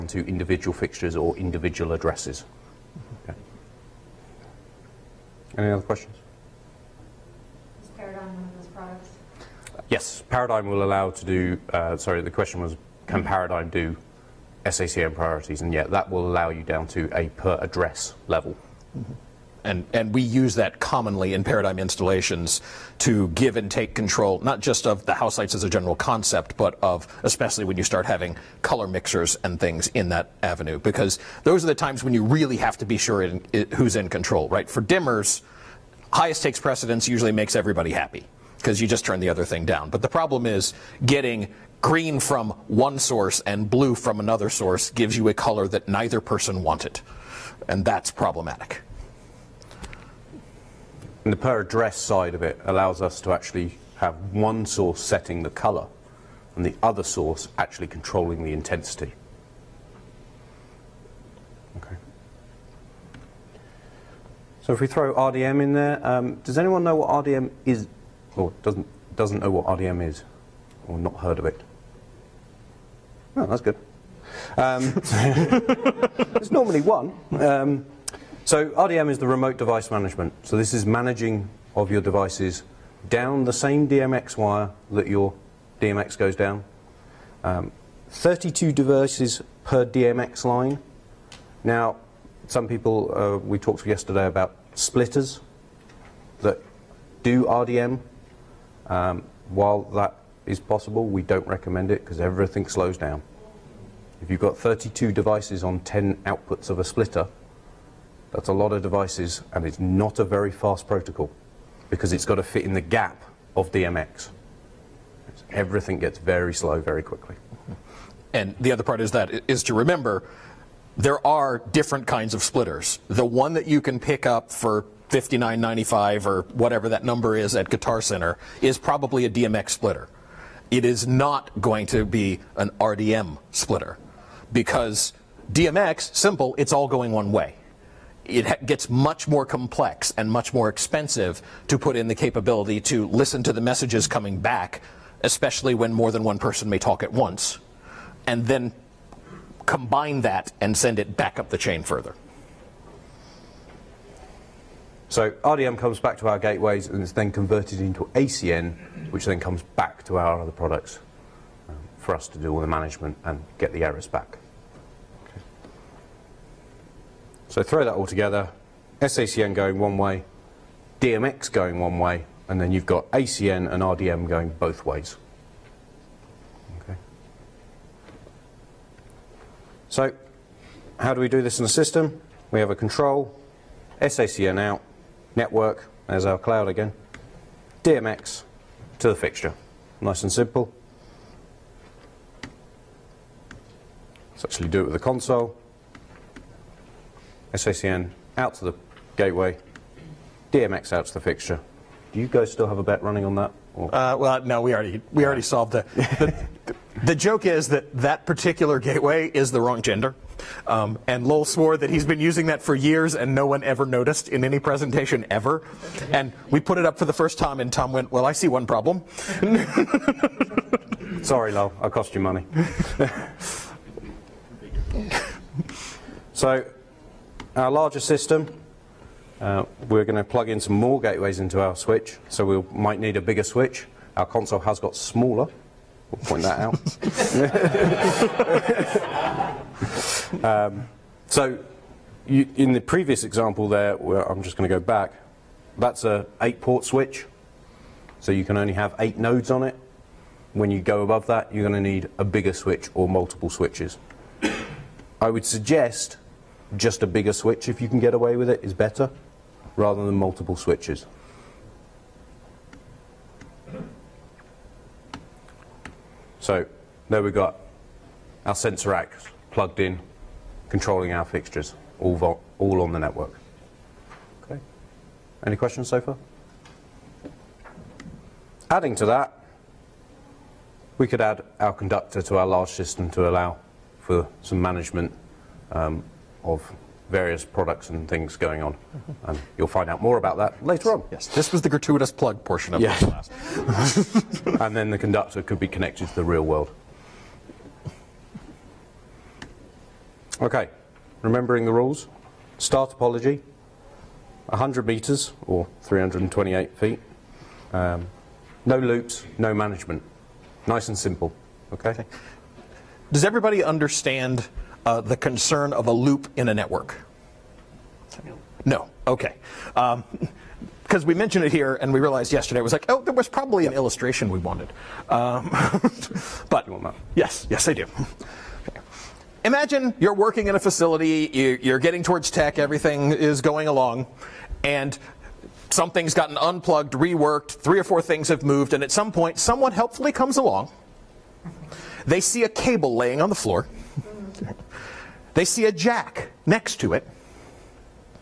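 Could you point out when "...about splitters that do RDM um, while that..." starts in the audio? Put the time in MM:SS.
01:34.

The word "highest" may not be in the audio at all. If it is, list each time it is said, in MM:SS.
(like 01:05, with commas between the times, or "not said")
00:36.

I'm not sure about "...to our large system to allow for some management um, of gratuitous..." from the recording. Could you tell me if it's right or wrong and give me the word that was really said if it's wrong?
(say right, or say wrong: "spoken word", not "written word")
wrong: "various", not "gratuitous".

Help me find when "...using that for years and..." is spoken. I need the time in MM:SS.
03:32.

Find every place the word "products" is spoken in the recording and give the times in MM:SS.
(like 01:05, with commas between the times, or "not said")
00:08, 02:40, 04:47.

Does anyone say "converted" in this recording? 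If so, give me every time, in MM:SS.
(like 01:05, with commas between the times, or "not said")
02:37.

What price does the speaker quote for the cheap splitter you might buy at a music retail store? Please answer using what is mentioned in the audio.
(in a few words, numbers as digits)
59.95.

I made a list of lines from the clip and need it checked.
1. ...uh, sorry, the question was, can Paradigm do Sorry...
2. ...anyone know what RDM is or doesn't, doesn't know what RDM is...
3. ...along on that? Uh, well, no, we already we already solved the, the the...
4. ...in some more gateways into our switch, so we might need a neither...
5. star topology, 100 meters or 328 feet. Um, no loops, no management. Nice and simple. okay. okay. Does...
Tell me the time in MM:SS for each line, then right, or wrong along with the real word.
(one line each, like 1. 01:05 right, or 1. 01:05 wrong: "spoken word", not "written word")
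1. 00:11 wrong: "SACN", not "Sorry"
2. 01:06 right
3. 03:23 wrong: "running", not "along"
4. 03:50 wrong: "bigger", not "neither"
5. 05:02 right.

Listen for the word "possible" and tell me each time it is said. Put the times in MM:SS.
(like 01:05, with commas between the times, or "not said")
01:40.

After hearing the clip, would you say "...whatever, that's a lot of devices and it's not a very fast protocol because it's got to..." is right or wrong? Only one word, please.
wrong.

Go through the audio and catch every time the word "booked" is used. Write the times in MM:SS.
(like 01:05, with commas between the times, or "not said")
not said.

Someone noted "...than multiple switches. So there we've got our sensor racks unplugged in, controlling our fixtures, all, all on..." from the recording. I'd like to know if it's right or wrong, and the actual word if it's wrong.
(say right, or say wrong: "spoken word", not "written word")
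wrong: "plugged", not "unplugged".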